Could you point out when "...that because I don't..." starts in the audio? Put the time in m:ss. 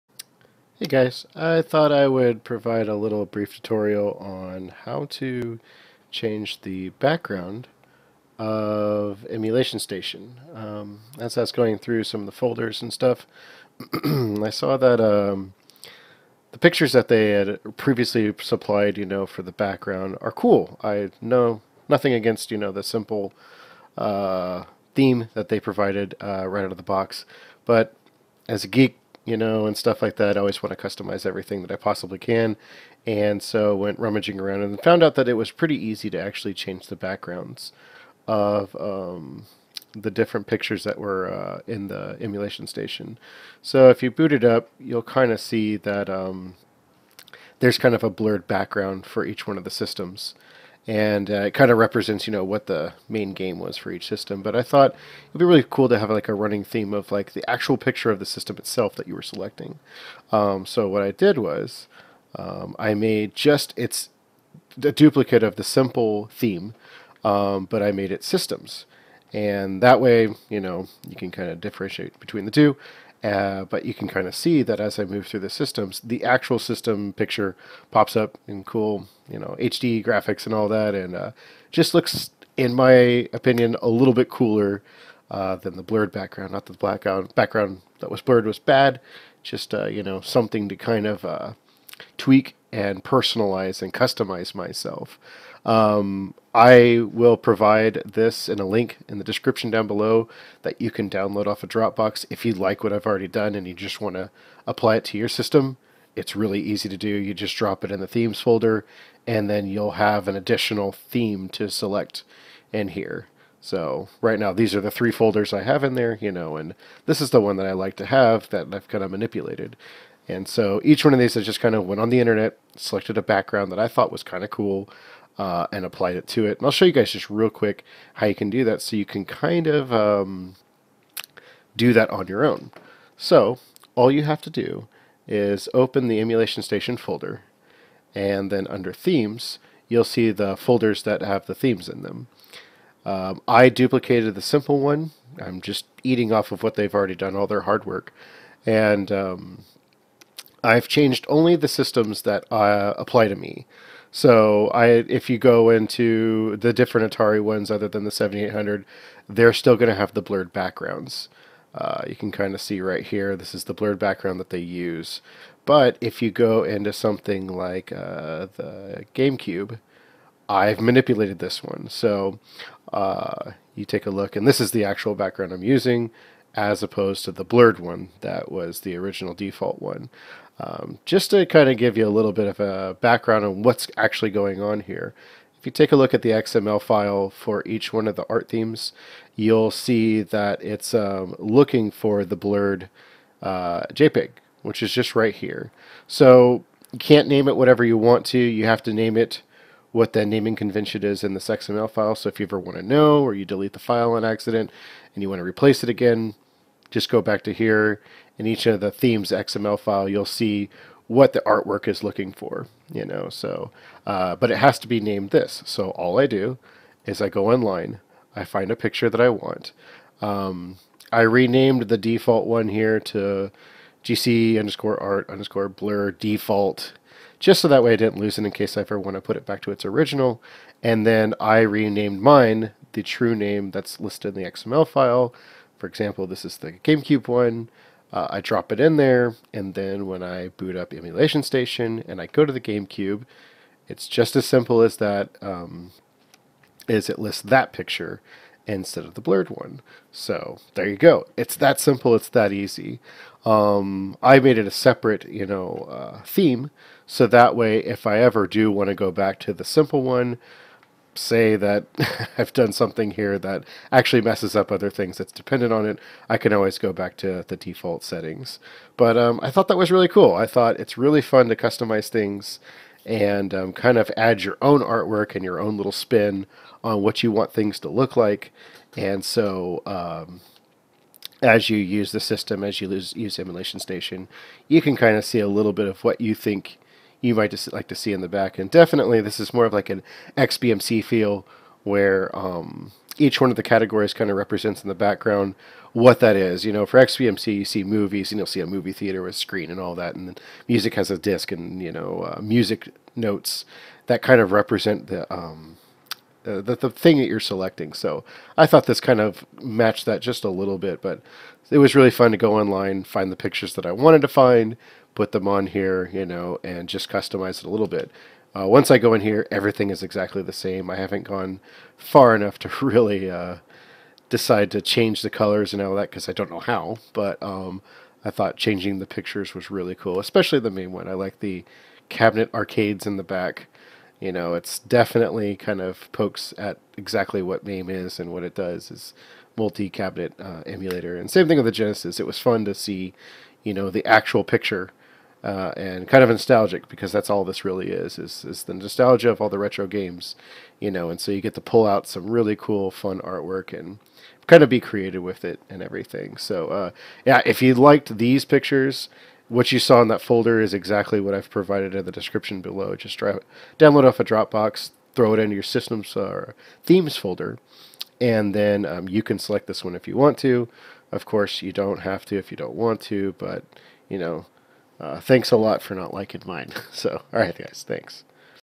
5:25.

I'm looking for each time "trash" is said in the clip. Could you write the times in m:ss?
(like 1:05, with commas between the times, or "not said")
not said.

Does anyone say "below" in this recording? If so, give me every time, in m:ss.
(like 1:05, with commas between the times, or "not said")
1:39, 6:02.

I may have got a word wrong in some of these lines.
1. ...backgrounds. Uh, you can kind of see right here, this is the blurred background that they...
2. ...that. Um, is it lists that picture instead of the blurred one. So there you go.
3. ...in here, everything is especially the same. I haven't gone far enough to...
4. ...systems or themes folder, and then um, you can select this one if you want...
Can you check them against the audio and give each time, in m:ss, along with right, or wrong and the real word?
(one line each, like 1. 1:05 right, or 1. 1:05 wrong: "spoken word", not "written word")
1. 2:40 right
2. 4:04 right
3. 5:19 wrong: "exactly", not "especially"
4. 6:05 right.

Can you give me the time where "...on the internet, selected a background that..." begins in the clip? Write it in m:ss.
2:01.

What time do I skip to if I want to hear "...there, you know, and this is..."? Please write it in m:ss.
1:55.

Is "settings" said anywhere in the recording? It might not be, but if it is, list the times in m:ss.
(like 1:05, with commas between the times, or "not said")
4:28.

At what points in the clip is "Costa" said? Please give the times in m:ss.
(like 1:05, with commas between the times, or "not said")
not said.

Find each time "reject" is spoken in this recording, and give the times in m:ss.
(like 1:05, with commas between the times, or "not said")
not said.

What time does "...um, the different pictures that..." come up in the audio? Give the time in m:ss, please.
0:38.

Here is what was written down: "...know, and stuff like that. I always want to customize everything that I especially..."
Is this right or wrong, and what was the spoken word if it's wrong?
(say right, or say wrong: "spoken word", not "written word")
wrong: "possibly", not "especially".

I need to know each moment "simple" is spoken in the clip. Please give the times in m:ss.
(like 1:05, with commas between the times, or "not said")
0:22, 1:05, 2:24, 4:04, 4:11, 4:19.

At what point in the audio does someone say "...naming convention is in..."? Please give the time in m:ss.
3:20.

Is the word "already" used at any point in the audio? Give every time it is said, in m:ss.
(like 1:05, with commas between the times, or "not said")
1:43, 2:26.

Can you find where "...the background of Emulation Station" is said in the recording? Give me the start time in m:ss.
0:06.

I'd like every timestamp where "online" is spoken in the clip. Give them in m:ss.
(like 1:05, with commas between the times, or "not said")
3:37, 5:12.